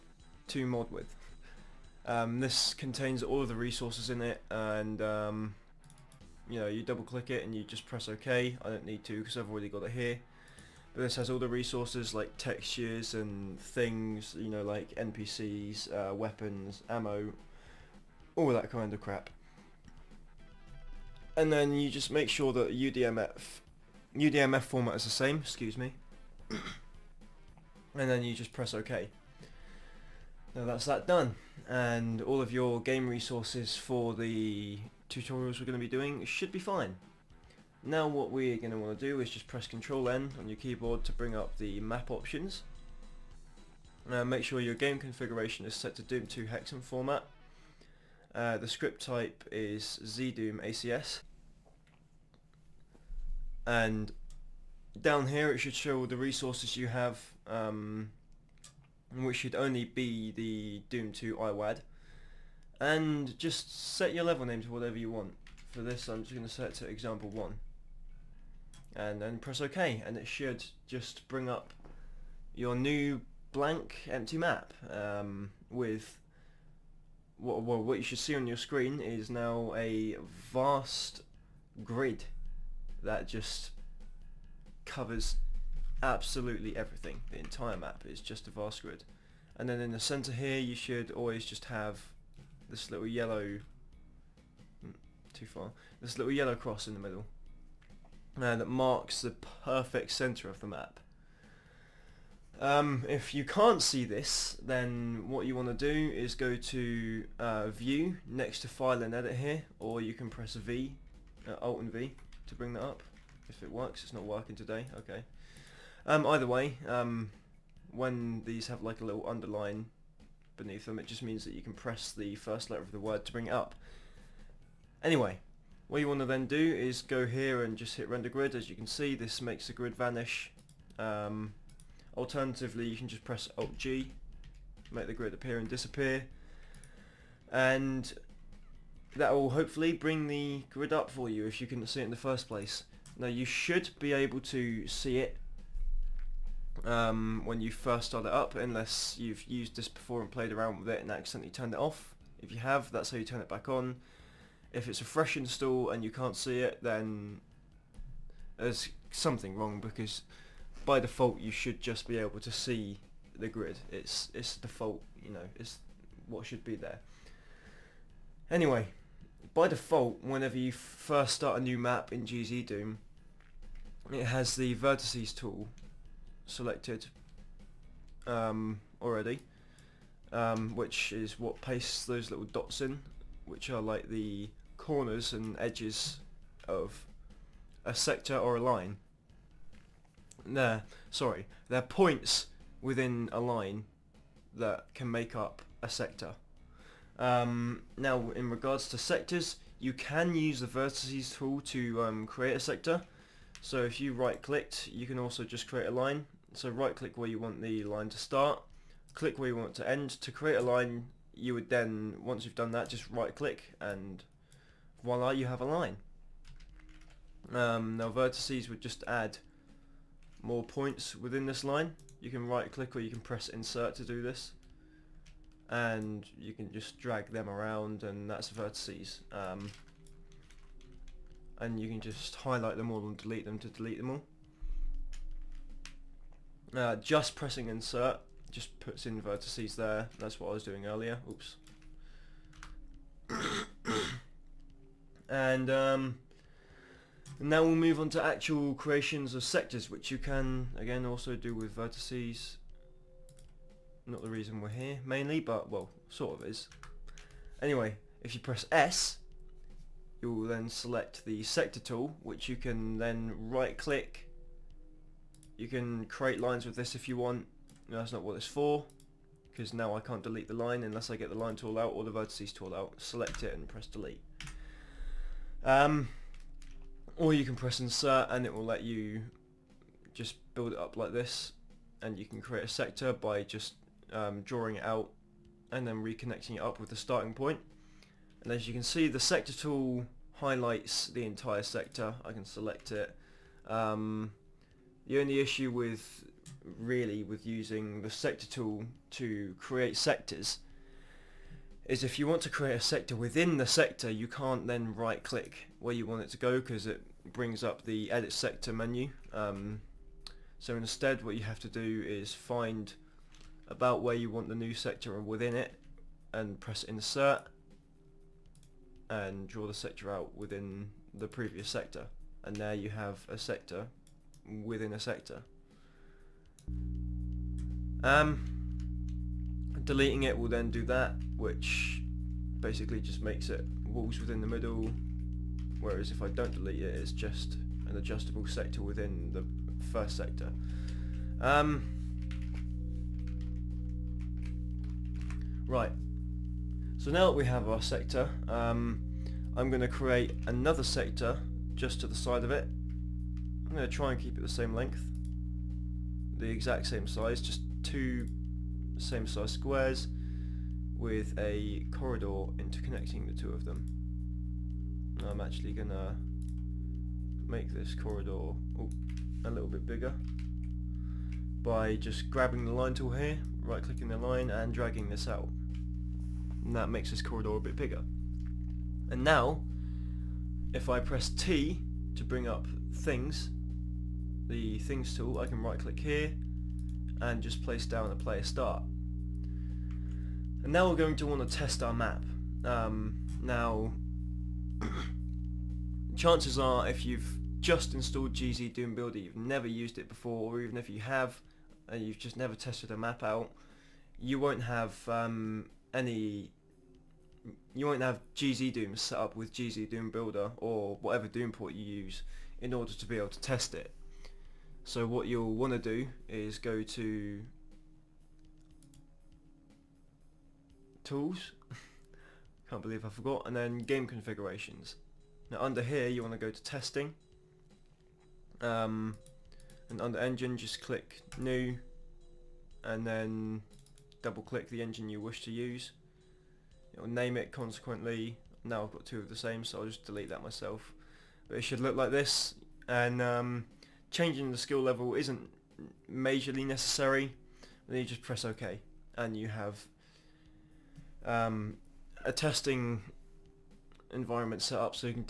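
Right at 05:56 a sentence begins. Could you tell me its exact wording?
The exact same size, just two same size squares with a corridor interconnecting the two of them.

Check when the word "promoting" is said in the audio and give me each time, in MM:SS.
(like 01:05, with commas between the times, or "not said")
not said.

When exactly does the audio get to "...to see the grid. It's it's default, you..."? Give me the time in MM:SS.
02:42.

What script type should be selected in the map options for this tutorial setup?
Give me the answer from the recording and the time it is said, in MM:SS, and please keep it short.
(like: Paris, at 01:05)
ZDoom ACS, at 00:50.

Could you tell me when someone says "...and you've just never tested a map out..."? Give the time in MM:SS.
06:41.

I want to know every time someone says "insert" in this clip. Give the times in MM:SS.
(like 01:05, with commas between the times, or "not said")
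03:43, 03:57, 04:37, 05:16.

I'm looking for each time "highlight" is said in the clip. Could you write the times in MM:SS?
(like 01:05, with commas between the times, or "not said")
03:52, 04:50.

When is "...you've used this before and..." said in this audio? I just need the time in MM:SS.
02:29.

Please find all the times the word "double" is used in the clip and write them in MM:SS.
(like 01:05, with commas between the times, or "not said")
00:06, 07:14.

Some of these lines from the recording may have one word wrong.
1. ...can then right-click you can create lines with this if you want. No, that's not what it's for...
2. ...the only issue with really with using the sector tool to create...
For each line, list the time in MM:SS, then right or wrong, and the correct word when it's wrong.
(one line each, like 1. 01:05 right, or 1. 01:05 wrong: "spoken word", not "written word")
1. 04:22 right
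2. 04:55 right.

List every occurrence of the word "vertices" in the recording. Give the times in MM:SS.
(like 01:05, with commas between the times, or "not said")
02:54, 03:20, 03:38, 03:48, 03:59, 04:11, 04:32.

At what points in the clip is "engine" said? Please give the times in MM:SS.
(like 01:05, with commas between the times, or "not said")
07:10, 07:14.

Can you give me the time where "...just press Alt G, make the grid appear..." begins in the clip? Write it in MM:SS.
02:13.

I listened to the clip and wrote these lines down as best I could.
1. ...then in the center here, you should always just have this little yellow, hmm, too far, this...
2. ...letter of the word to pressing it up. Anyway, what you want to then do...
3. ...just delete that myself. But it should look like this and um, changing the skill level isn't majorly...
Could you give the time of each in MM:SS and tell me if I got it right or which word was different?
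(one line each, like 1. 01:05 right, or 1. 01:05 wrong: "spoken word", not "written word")
1. 01:29 right
2. 02:02 wrong: "bring", not "pressing"
3. 07:19 right.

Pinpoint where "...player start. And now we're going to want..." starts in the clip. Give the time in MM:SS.
06:28.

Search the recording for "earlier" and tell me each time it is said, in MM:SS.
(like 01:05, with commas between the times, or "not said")
04:00.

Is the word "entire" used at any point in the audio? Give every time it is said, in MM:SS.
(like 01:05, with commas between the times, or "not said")
01:27, 04:51.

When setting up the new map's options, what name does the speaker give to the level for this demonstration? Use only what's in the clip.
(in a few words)
example 1.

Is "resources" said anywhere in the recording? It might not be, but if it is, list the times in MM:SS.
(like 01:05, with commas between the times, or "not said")
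00:03, 00:11, 00:33, 00:56.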